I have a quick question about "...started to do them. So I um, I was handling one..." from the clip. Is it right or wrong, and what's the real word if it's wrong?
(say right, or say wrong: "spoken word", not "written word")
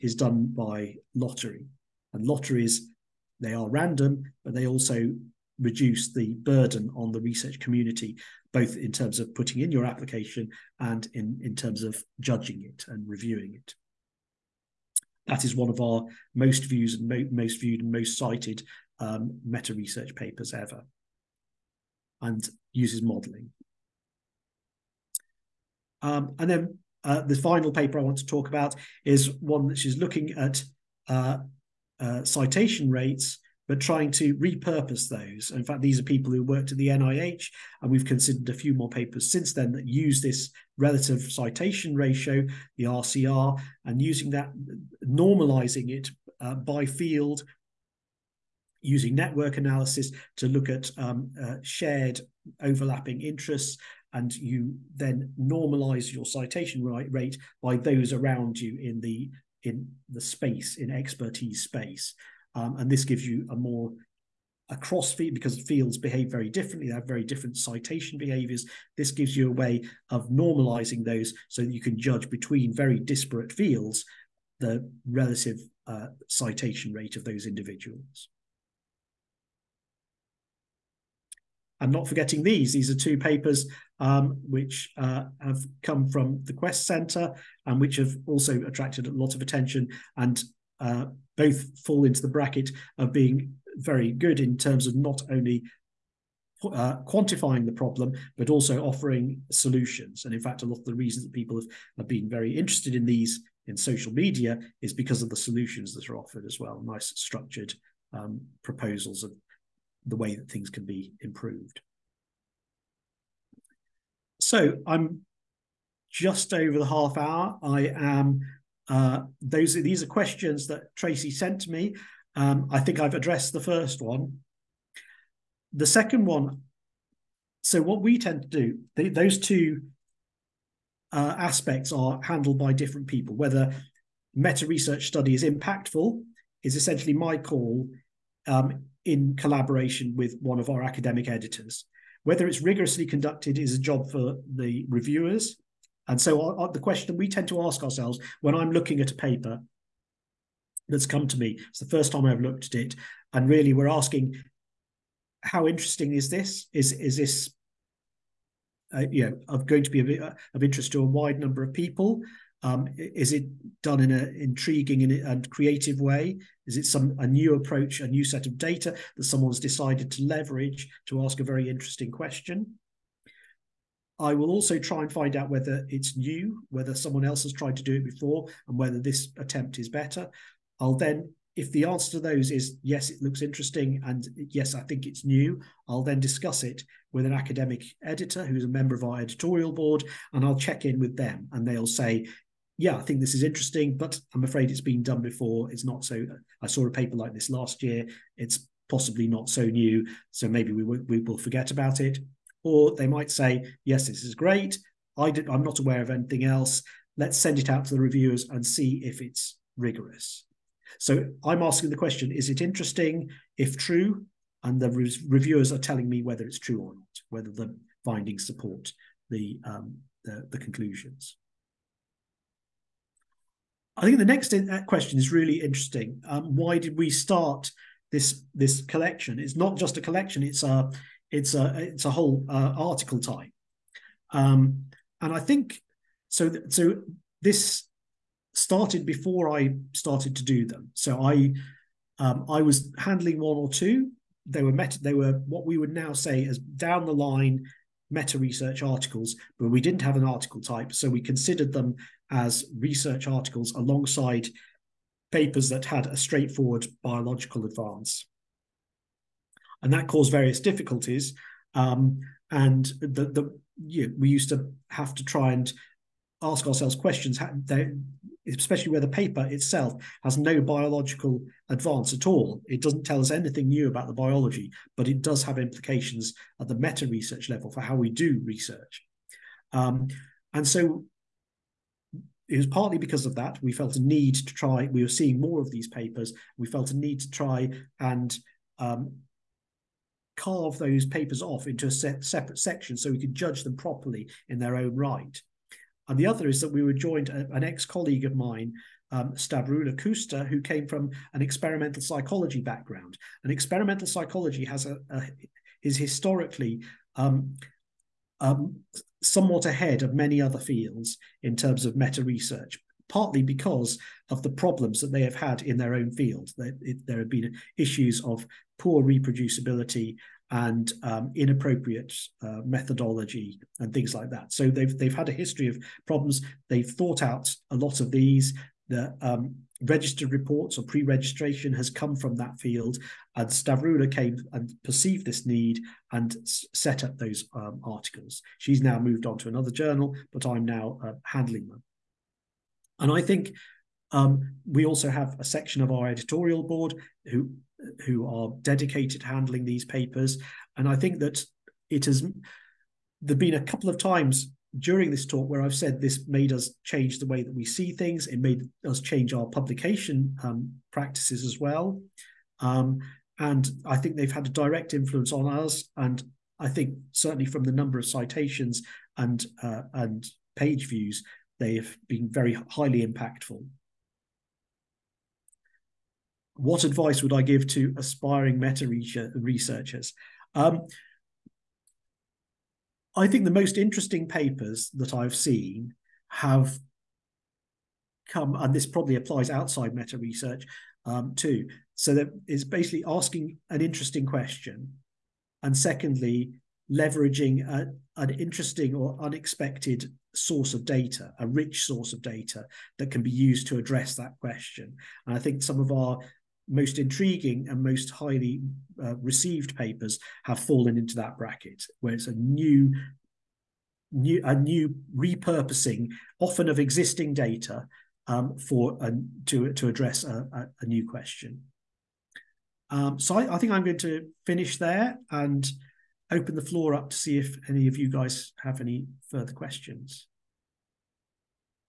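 right.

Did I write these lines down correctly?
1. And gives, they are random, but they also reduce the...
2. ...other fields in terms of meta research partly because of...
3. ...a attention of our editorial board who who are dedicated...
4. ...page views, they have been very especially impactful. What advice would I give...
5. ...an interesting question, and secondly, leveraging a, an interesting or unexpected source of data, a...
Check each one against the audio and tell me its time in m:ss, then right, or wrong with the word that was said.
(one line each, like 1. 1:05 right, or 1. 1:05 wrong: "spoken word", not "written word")
1. 0:02 wrong: "lotteries", not "gives"
2. 5:10 right
3. 5:45 wrong: "section", not "attention"
4. 6:10 wrong: "highly", not "especially"
5. 6:33 right.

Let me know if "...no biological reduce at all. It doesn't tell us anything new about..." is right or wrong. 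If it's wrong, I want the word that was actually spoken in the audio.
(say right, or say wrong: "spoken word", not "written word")
wrong: "advance", not "reduce".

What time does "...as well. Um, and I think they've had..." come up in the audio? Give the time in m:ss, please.
6:01.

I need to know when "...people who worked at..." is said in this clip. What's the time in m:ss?
0:36.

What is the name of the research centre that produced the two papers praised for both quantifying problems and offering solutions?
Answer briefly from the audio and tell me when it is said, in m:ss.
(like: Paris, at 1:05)
Quest Centre, at 1:26.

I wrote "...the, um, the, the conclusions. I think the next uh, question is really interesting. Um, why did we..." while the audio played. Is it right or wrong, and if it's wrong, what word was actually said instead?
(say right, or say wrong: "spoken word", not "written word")
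right.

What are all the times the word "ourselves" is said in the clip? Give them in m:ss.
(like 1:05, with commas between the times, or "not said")
2:27, 4:26.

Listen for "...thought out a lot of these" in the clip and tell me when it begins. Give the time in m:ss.
5:26.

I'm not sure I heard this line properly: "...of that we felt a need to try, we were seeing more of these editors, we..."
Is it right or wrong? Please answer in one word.
wrong.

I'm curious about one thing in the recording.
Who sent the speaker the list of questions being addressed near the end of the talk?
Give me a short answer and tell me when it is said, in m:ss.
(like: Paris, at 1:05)
Tracey, at 2:00.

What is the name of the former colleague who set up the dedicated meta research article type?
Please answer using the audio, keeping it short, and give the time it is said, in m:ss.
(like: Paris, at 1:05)
Stavroula Kousta, at 4:59.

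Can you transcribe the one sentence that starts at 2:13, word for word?
Whether meta research study is impactful is essentially my call um, in collaboration with one of our academic editors.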